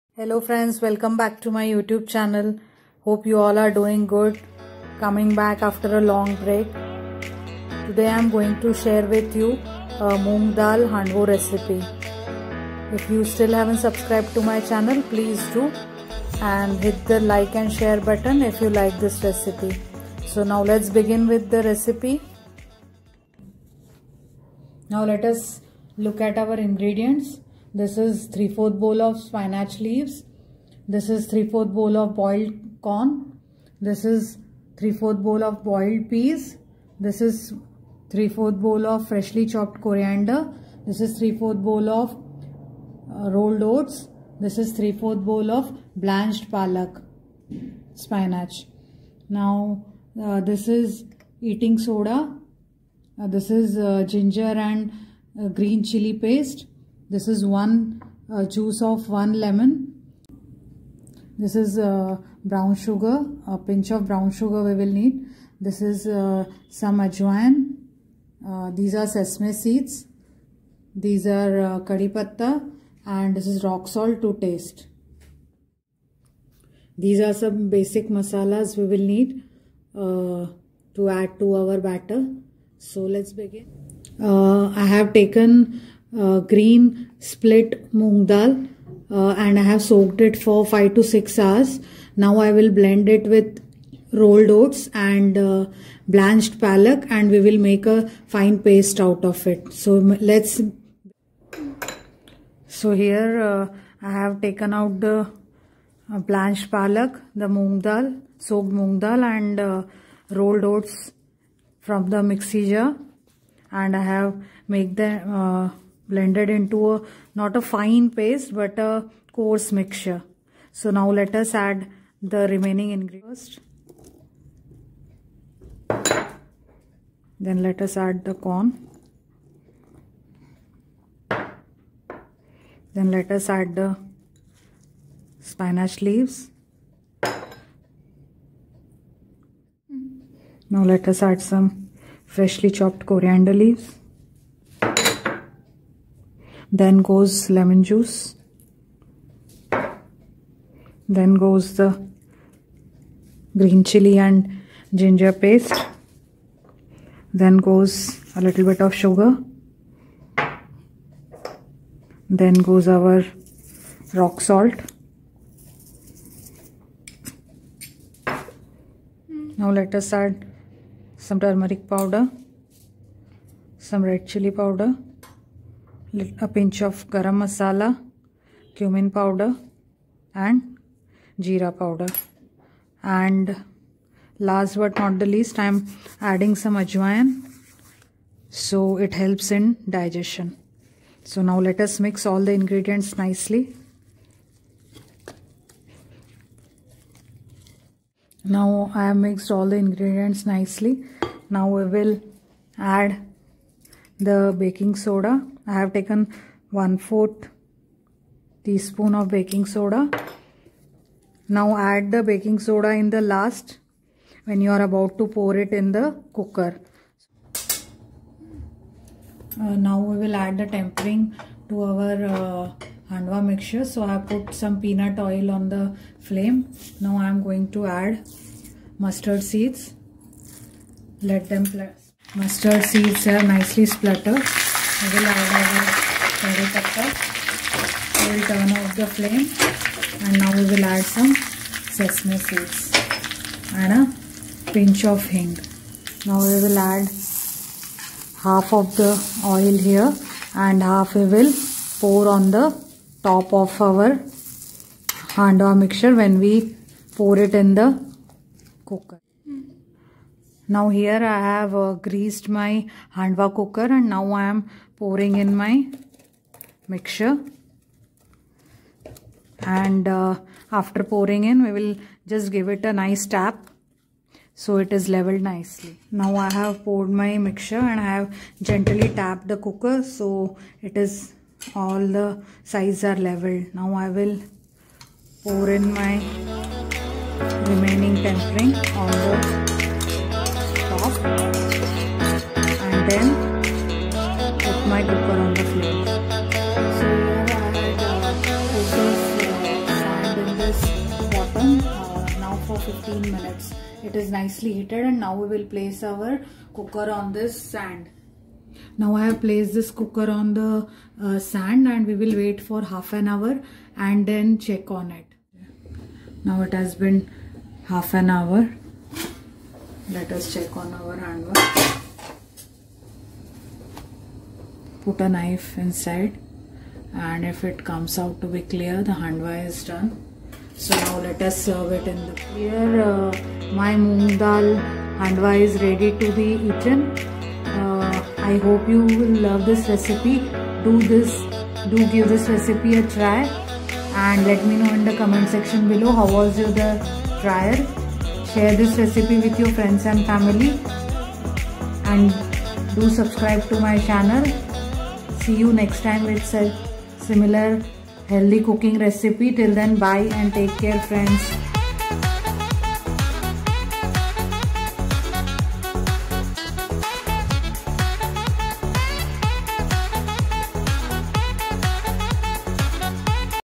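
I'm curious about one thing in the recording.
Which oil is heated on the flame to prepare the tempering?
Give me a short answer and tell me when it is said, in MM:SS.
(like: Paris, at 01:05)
Peanut oil, at 03:44.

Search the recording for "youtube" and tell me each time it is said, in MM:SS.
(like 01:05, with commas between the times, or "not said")
00:01.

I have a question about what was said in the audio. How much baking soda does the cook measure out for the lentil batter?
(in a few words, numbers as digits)
1 teaspoon.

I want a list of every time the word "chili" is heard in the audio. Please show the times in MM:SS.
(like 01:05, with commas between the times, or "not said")
00:55, 02:33, 02:54.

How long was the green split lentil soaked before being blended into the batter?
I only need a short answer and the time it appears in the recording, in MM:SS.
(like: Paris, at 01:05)
5 to 6 hours, at 01:30.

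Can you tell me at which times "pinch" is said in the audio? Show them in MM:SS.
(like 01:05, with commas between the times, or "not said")
01:03, 02:56, 04:04.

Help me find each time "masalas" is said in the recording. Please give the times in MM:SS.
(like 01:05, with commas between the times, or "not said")
01:18, 02:57.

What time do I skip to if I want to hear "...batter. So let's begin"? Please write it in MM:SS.
01:21.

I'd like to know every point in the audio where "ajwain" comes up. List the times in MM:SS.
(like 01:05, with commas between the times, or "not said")
01:06, 03:06.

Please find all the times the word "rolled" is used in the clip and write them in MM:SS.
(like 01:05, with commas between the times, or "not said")
00:43, 01:34, 01:50.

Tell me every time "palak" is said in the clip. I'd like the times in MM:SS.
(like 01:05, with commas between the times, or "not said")
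00:46, 01:36, 01:46.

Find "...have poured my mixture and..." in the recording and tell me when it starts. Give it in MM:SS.
04:36.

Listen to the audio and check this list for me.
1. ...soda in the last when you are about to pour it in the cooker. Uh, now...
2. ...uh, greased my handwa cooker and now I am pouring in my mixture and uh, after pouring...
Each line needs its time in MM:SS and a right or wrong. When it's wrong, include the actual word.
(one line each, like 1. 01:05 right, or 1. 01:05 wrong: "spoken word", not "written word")
1. 03:32 right
2. 04:21 right.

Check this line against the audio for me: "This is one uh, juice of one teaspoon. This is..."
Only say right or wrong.
wrong.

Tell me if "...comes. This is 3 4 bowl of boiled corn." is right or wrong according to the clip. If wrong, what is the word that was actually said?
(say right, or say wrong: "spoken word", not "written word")
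wrong: "leaves", not "comes".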